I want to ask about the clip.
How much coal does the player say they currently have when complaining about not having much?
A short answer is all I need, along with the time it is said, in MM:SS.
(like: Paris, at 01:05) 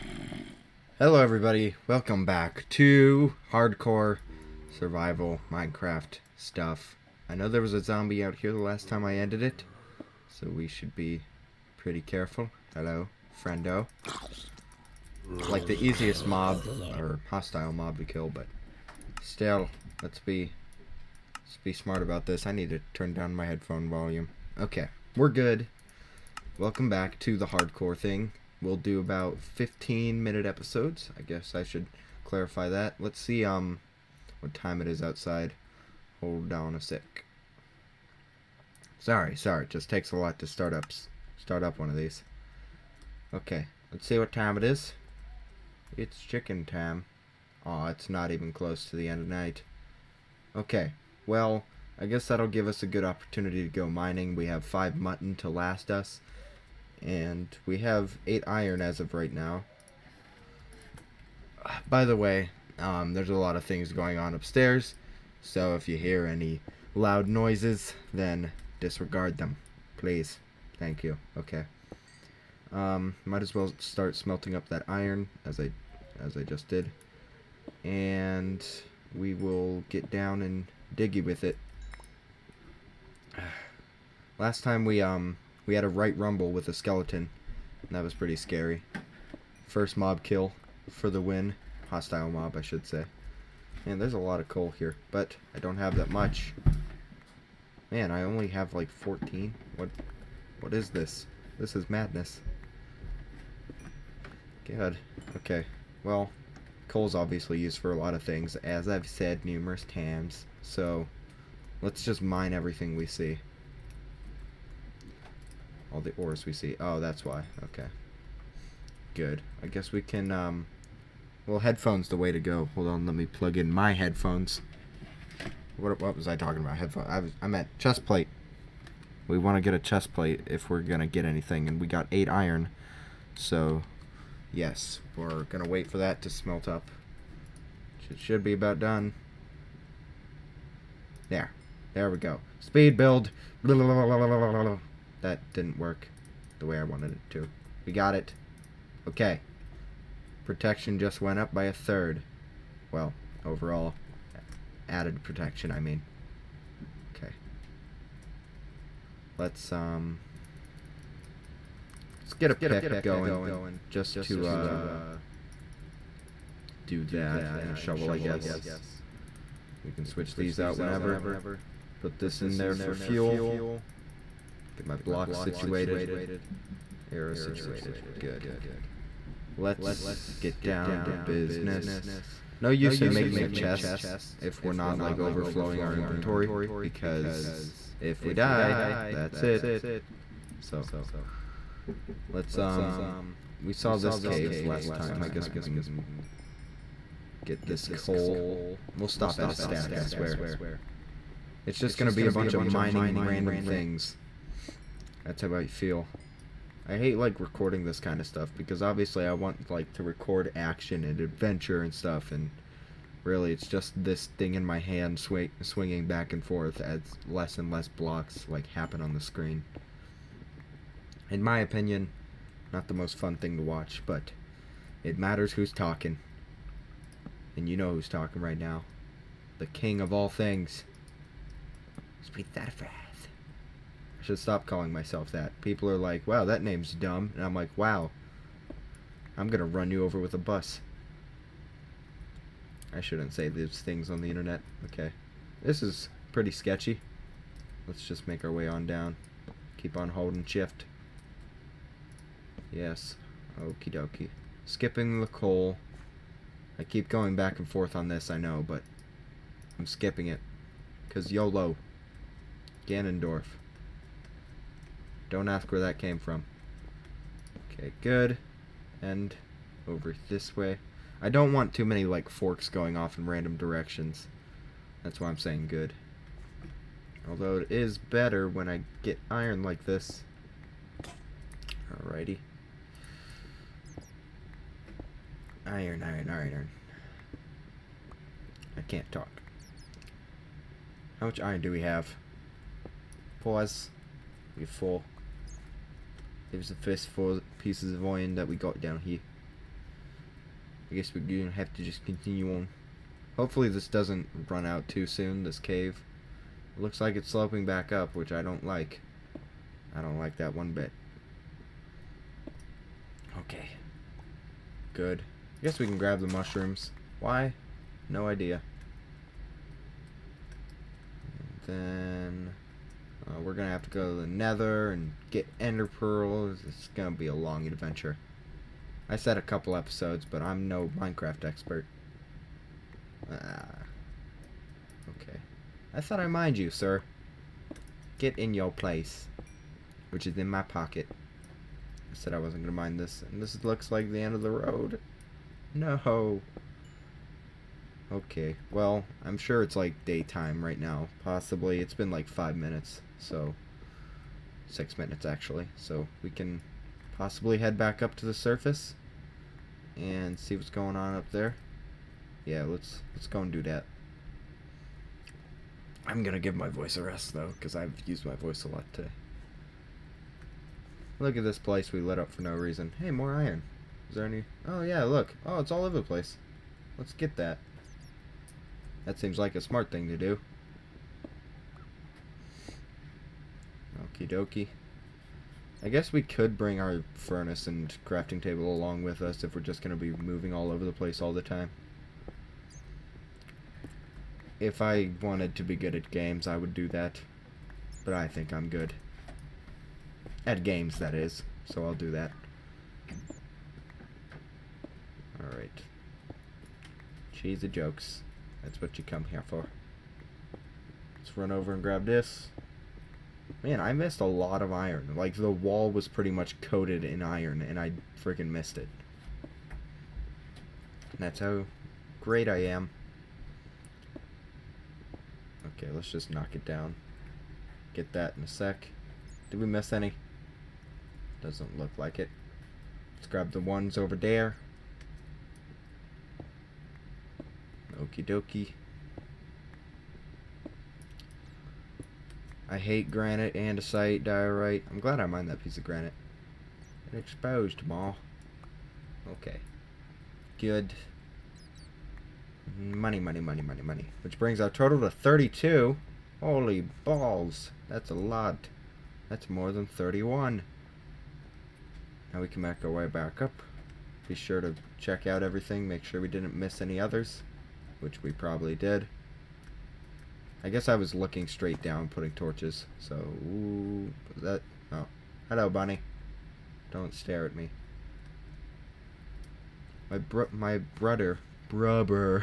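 14, at 01:38.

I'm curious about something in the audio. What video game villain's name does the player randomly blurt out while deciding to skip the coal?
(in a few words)
Ganondorf.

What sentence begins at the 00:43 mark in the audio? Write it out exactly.
Okay, let's see what time it is.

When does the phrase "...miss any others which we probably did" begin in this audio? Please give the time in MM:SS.
07:46.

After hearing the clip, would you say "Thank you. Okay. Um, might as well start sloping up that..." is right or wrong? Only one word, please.
wrong.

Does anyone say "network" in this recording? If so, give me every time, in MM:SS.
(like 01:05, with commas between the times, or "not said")
not said.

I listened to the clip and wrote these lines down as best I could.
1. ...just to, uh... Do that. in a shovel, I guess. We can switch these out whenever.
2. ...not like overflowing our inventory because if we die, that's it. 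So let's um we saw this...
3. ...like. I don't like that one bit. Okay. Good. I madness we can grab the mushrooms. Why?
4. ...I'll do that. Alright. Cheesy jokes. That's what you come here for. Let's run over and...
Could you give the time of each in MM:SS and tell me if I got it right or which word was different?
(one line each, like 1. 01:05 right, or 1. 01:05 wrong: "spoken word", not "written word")
1. 02:43 right
2. 03:04 right
3. 05:08 wrong: "guess", not "madness"
4. 06:41 right.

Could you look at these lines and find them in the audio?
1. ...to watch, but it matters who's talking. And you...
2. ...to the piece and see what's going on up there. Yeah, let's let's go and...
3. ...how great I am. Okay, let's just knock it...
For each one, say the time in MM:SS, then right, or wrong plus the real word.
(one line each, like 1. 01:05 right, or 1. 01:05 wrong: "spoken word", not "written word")
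1. 03:43 right
2. 05:58 wrong: "surface", not "piece"
3. 07:01 right.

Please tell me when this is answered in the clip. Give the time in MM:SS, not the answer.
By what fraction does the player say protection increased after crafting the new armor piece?
02:31.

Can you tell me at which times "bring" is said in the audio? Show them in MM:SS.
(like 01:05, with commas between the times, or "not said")
06:26, 07:34.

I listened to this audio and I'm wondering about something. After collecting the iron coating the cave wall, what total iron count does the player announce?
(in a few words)
32.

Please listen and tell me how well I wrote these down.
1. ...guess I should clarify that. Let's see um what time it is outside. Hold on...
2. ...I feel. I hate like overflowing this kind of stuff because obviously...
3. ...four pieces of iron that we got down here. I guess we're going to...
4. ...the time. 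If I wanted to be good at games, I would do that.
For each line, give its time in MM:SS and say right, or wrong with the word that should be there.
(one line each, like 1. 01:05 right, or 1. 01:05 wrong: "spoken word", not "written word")
1. 00:31 right
2. 03:25 wrong: "recording", not "overflowing"
3. 04:57 right
4. 06:31 right.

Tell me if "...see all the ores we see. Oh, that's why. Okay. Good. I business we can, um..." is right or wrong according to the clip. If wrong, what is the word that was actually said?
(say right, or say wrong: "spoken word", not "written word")
wrong: "guess", not "business".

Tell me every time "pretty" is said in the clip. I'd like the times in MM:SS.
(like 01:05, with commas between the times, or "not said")
00:11, 01:28, 04:06, 06:56.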